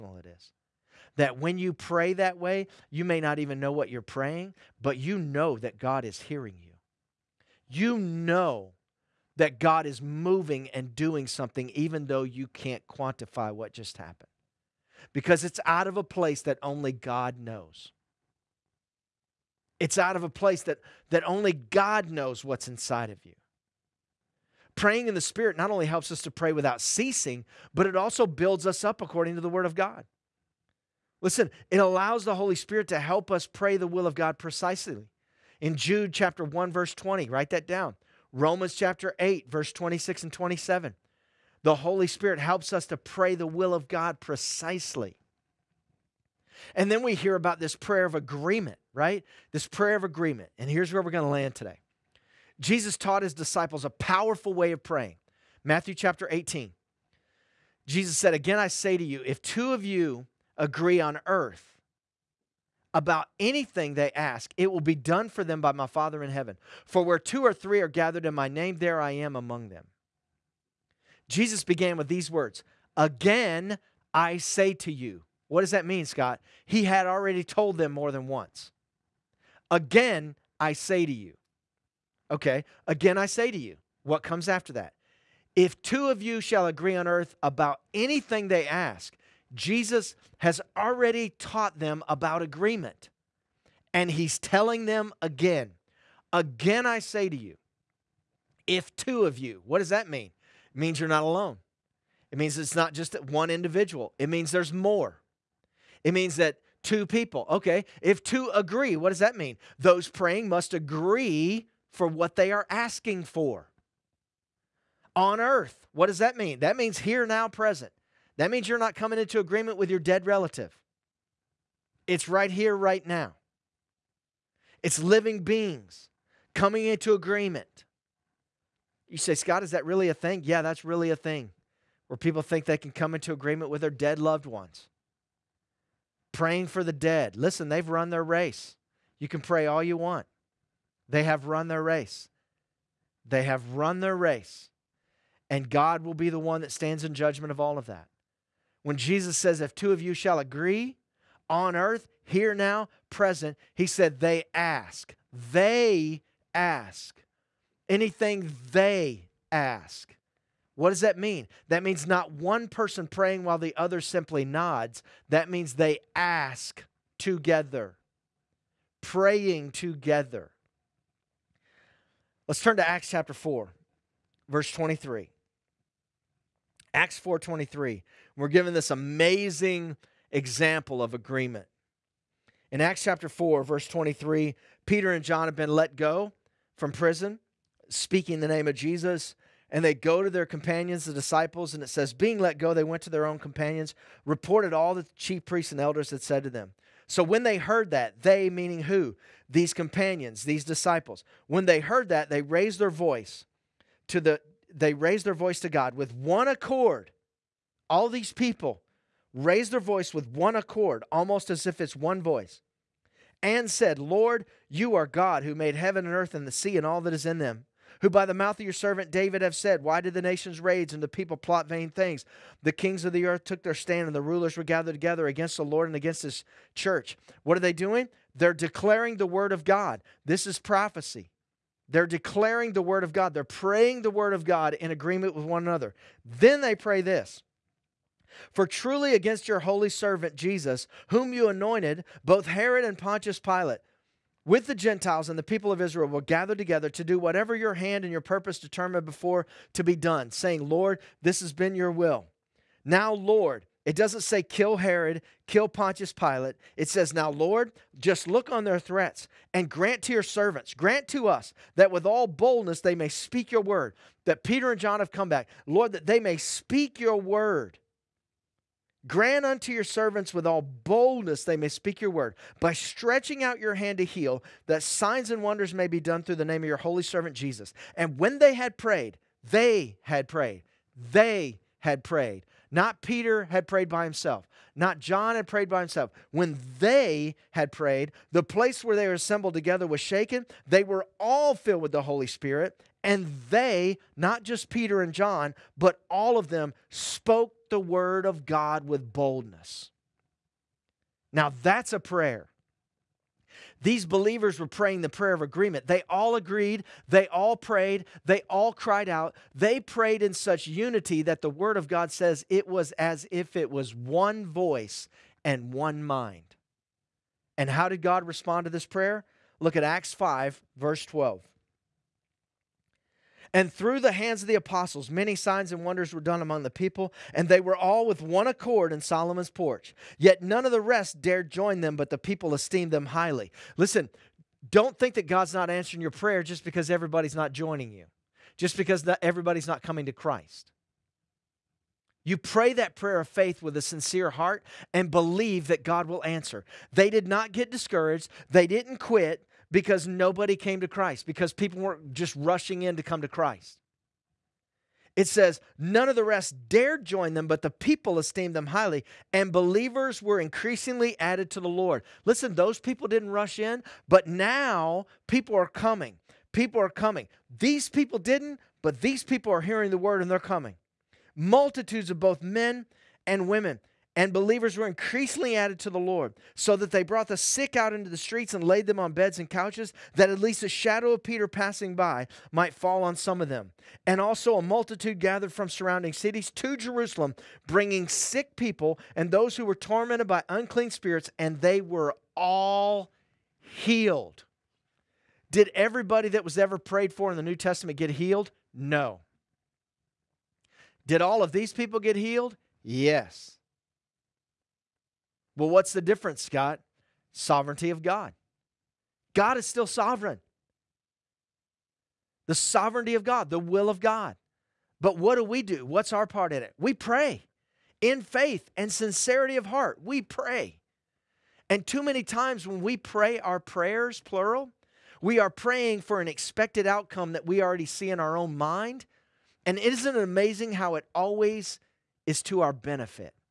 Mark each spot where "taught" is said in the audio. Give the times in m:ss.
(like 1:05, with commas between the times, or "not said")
0:52, 1:31.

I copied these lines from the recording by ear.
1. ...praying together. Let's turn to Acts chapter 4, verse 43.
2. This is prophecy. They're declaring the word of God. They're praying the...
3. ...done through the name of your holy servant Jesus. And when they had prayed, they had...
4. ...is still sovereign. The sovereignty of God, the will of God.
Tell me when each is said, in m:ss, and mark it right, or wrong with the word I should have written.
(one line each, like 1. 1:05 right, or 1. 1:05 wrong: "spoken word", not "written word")
1. 2:49 wrong: "23", not "43"
2. 3:50 right
3. 4:35 right
4. 6:49 right.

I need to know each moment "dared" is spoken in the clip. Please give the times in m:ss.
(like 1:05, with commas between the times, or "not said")
5:31, 5:56.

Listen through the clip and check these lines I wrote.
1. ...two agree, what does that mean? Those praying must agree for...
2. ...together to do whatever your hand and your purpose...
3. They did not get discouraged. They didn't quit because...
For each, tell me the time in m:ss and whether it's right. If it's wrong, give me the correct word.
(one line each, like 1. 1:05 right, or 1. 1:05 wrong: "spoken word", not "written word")
1. 1:48 right
2. 4:06 right
3. 5:46 right.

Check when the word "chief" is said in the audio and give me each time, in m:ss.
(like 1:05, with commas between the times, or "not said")
3:15.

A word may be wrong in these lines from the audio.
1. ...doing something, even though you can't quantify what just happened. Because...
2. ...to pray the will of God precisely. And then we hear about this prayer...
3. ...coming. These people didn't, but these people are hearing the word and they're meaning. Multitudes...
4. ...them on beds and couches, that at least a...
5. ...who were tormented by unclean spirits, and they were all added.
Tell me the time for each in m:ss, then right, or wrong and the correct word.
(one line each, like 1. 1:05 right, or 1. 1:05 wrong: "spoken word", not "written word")
1. 0:10 right
2. 0:42 right
3. 6:06 wrong: "coming", not "meaning"
4. 6:18 right
5. 6:29 wrong: "healed", not "added".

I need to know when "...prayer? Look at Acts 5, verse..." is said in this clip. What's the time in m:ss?
5:18.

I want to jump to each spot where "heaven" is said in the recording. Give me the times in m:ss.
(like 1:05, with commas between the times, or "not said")
1:06, 3:35.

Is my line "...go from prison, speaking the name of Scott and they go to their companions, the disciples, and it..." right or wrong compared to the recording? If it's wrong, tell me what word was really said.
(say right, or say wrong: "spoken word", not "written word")
wrong: "Jesus", not "Scott".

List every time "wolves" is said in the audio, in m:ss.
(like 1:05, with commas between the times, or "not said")
not said.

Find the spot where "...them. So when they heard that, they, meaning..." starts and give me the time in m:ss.
3:16.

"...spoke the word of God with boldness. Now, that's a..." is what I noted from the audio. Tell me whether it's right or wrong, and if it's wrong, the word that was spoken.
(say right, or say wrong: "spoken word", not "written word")
right.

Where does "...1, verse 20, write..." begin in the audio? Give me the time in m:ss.
0:36.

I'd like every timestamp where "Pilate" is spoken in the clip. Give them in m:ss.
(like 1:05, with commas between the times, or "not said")
4:03, 4:16.